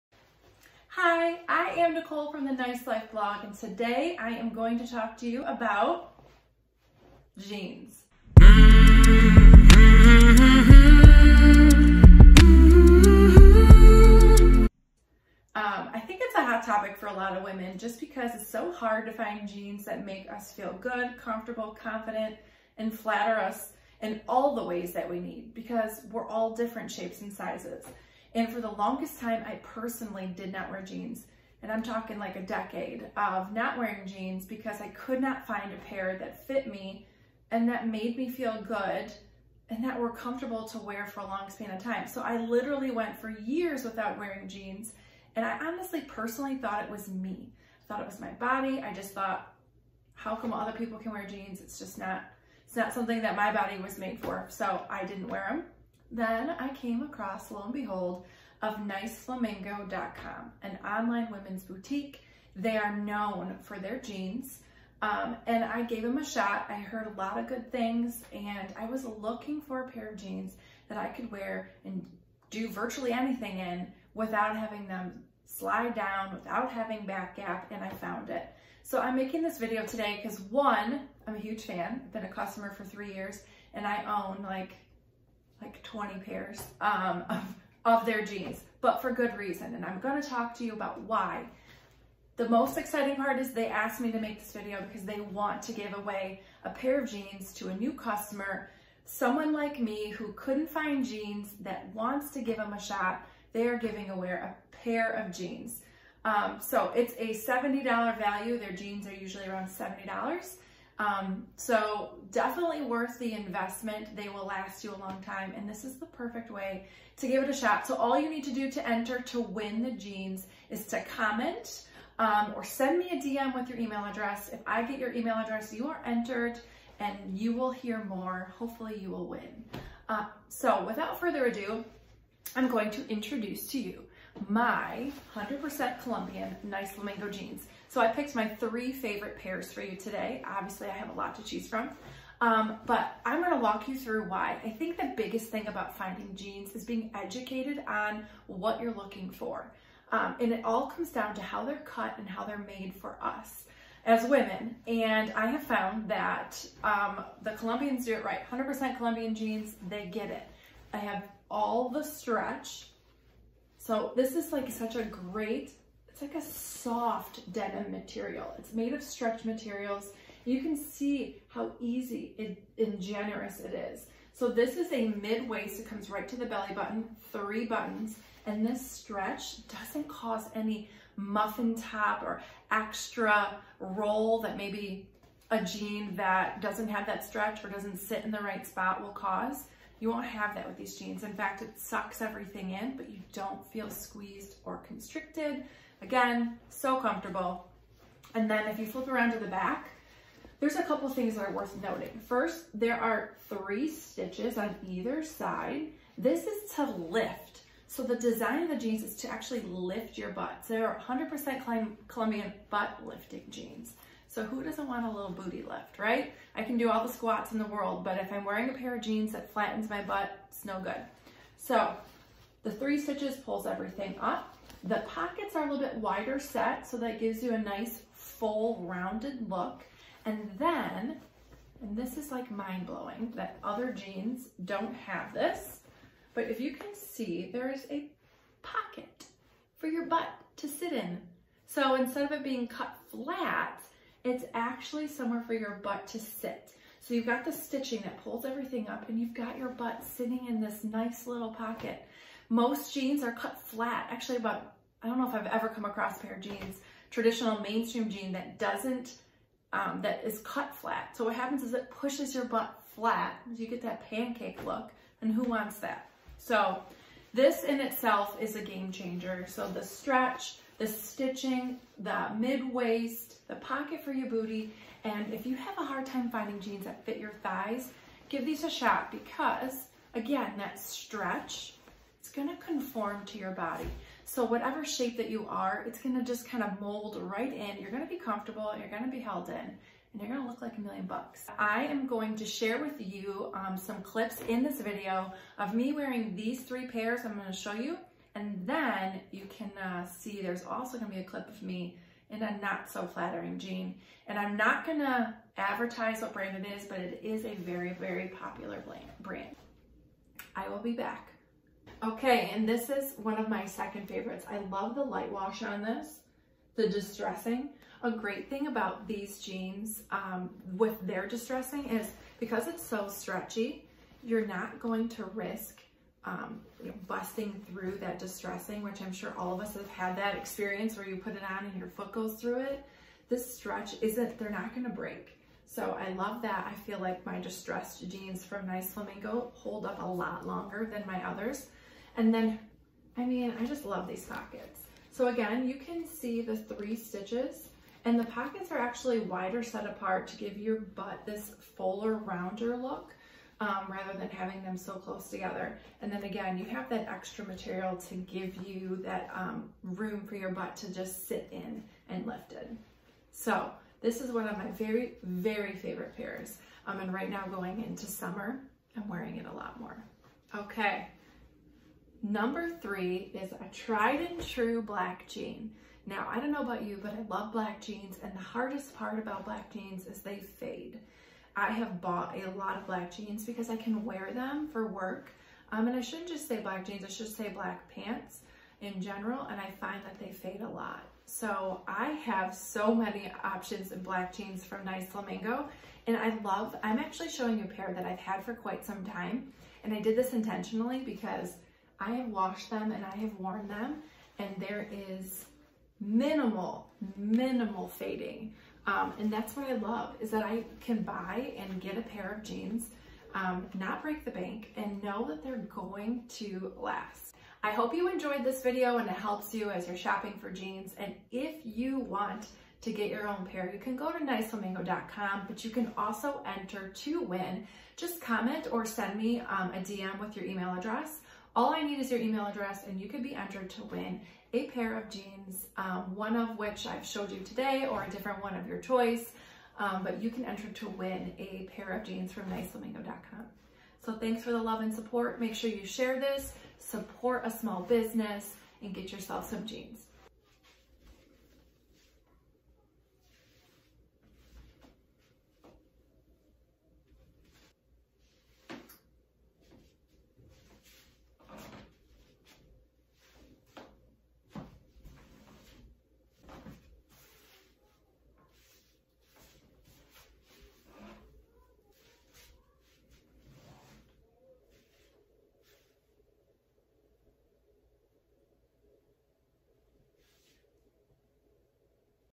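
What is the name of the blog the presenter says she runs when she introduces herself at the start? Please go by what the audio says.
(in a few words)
Nice Life.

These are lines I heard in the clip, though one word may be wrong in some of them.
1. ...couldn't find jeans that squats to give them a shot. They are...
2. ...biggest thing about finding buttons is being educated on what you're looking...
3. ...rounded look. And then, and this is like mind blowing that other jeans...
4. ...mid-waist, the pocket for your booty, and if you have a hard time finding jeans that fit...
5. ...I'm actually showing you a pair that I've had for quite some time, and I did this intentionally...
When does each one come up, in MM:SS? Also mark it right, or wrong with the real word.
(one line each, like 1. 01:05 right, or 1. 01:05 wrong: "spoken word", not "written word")
1. 01:40 wrong: "wants", not "squats"
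2. 02:25 wrong: "jeans", not "buttons"
3. 03:48 right
4. 04:32 right
5. 06:36 right.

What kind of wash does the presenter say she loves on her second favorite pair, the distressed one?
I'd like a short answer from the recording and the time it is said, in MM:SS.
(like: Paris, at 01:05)
light wash, at 05:15.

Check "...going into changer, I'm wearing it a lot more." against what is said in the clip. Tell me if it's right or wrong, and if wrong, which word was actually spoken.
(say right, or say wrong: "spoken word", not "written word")
wrong: "summer", not "changer".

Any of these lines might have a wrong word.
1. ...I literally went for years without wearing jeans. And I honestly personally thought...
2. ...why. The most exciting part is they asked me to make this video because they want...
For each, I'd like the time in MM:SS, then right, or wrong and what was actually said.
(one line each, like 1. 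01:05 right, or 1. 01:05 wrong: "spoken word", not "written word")
1. 00:42 right
2. 01:31 right.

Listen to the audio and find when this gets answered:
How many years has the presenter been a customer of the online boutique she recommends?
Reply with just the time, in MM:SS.
01:22.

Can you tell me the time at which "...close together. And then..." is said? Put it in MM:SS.
05:54.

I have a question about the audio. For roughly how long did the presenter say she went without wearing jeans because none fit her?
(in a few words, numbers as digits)
a decade.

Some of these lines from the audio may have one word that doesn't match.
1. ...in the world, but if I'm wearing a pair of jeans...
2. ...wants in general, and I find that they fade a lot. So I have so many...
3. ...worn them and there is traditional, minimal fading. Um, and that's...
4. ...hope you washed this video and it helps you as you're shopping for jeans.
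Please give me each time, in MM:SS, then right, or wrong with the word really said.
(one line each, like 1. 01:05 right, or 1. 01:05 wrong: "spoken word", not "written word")
1. 03:37 right
2. 06:27 wrong: "pants", not "wants"
3. 06:43 wrong: "minimal", not "traditional"
4. 06:57 wrong: "enjoyed", not "washed".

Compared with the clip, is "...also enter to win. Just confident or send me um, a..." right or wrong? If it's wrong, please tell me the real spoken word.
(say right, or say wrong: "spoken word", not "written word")
wrong: "comment", not "confident".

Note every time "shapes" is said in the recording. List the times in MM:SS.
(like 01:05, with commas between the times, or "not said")
00:26, 04:44.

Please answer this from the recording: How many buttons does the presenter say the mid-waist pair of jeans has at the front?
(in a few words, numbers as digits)
3.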